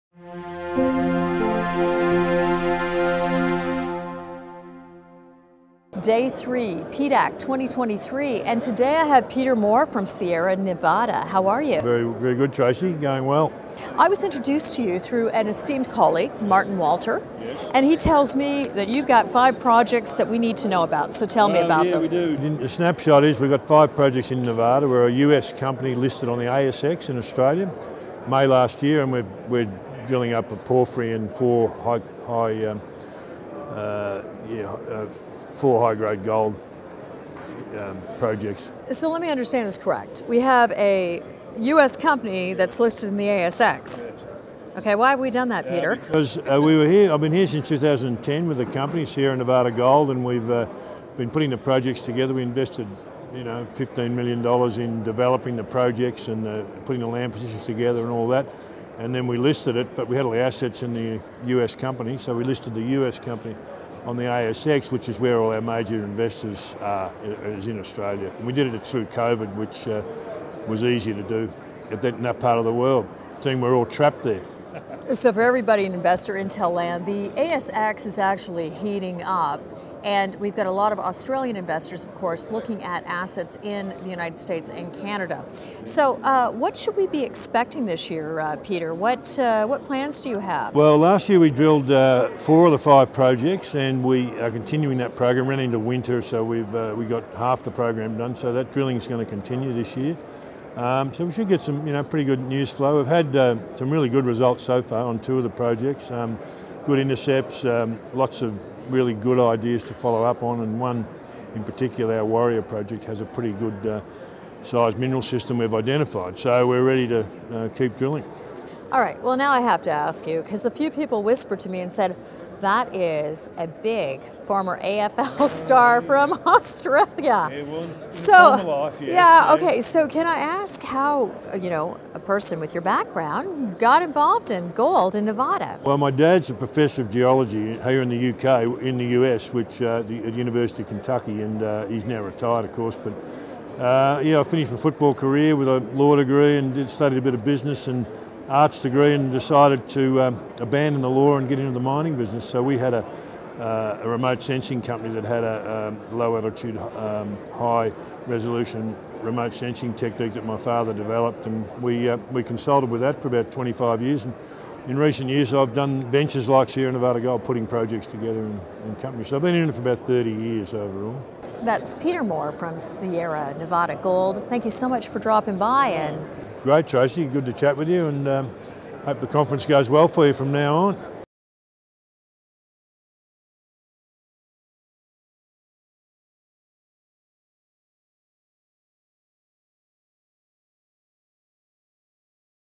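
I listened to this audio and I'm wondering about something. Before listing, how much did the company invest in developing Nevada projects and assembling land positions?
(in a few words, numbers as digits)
15 million dollars.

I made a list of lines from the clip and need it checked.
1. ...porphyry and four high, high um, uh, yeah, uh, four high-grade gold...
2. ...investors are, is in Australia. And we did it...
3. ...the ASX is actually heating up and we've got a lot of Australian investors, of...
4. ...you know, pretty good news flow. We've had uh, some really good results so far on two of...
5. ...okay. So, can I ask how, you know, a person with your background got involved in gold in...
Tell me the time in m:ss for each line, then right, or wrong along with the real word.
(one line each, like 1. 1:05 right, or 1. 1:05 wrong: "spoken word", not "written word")
1. 0:30 right
2. 1:06 right
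3. 1:17 right
4. 1:41 right
5. 2:09 right.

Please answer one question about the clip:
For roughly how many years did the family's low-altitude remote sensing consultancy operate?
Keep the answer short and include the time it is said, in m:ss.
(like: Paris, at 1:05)
25 years, at 2:43.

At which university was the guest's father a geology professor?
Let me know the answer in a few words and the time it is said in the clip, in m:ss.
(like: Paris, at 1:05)
University of Kentucky, at 2:20.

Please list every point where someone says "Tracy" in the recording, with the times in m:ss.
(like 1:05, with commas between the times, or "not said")
0:12, 2:56.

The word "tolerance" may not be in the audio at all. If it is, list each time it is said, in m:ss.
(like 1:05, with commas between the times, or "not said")
not said.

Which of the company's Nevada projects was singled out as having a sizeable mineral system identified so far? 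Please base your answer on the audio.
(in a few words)
Warrior.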